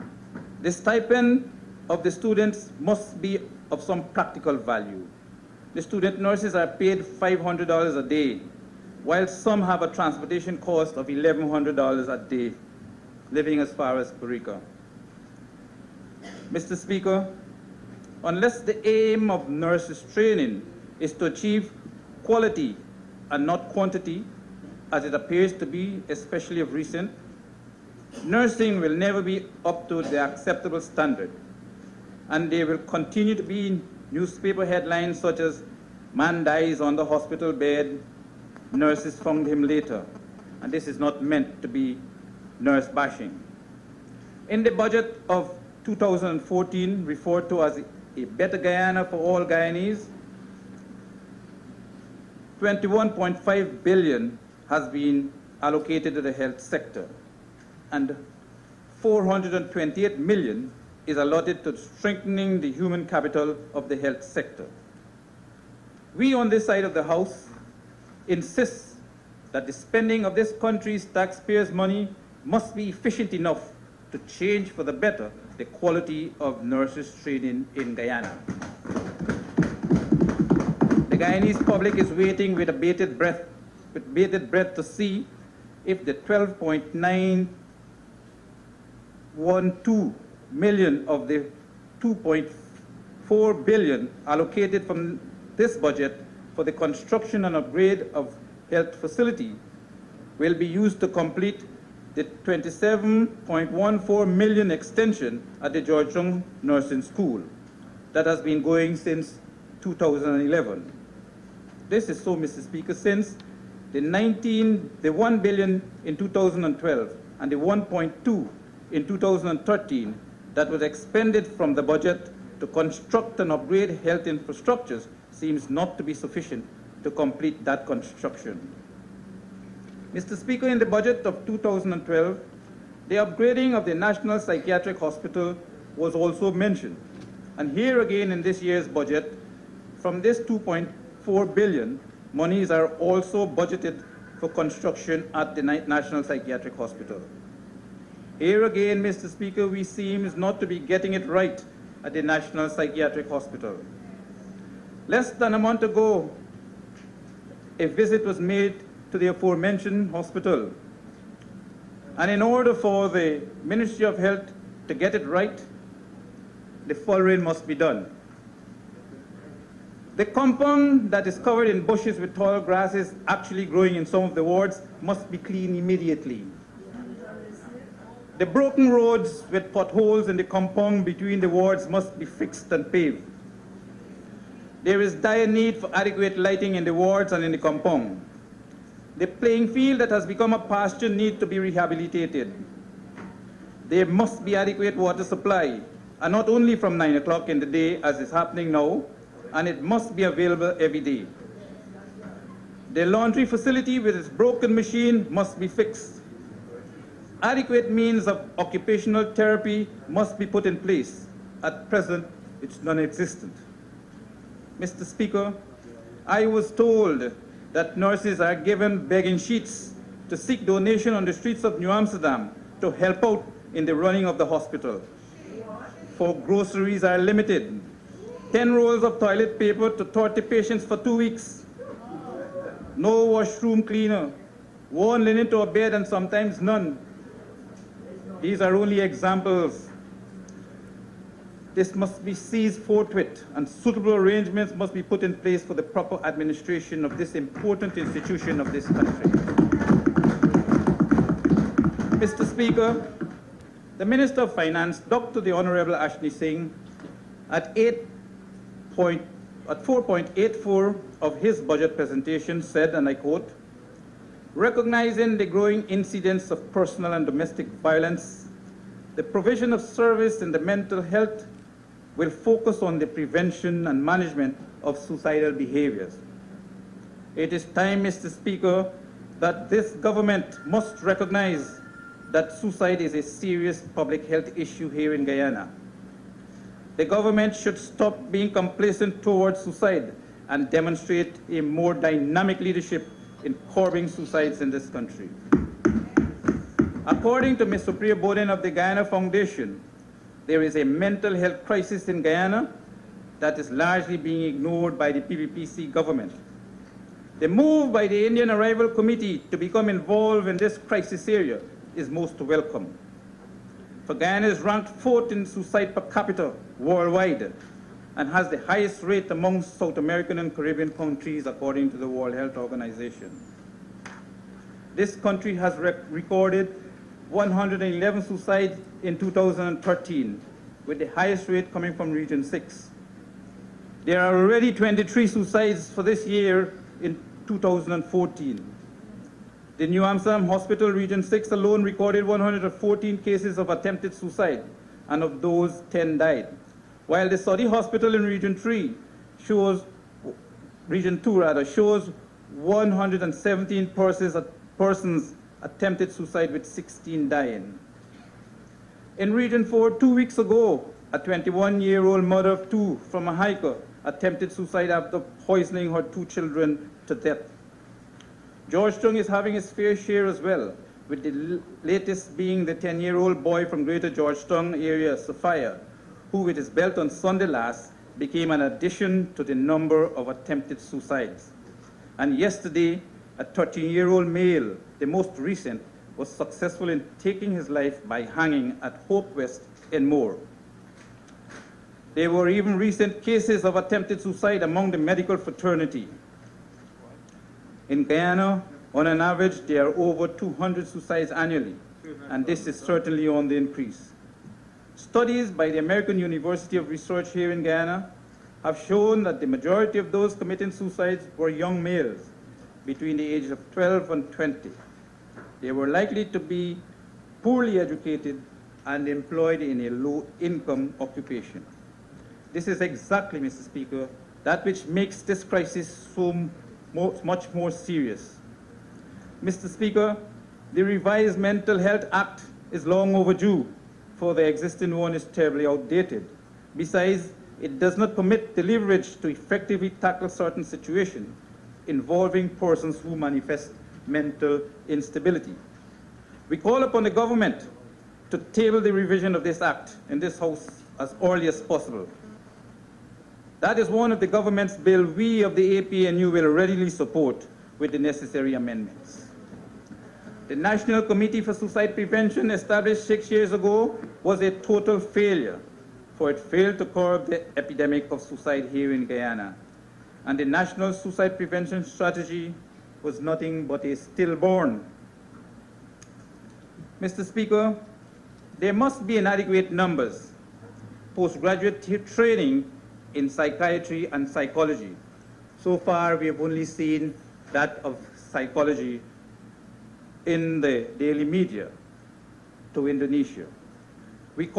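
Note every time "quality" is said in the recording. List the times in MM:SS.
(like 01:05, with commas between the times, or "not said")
00:22, 01:15.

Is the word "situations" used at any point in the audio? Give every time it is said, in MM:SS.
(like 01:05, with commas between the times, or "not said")
07:20.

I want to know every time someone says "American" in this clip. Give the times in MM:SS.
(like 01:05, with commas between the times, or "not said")
05:19, 06:45.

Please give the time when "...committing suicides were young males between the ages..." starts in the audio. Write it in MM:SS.
06:50.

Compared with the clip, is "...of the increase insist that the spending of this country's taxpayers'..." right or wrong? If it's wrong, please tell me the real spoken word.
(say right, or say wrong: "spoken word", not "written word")
wrong: "house", not "increase".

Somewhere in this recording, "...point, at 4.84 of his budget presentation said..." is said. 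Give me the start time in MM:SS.
04:18.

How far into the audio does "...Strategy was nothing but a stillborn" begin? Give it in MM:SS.
07:51.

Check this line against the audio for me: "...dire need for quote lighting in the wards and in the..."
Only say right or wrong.
wrong.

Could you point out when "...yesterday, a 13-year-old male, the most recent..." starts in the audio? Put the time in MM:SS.
06:22.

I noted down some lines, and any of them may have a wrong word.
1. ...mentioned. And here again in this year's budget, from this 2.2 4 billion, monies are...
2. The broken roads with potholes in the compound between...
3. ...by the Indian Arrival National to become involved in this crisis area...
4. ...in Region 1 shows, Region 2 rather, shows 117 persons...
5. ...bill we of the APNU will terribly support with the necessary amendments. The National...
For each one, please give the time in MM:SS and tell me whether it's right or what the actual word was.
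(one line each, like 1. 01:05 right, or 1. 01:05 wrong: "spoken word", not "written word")
1. 02:16 right
2. 02:58 right
3. 05:07 wrong: "Committee", not "National"
4. 05:48 wrong: "3", not "1"
5. 07:34 wrong: "readily", not "terribly".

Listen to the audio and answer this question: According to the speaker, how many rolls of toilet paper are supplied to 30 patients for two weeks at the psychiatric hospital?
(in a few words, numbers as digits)
10.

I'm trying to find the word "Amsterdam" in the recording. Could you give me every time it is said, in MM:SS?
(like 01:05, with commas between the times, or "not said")
03:41, 05:40.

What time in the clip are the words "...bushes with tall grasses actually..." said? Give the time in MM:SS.
02:51.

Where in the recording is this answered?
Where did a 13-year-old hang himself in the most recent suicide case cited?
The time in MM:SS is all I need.
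06:29.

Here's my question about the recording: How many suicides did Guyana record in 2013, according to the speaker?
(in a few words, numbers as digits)
111.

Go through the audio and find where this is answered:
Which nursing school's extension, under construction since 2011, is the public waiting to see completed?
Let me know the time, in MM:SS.
01:45.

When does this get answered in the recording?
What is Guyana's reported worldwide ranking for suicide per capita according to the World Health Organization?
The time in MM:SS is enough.
05:15.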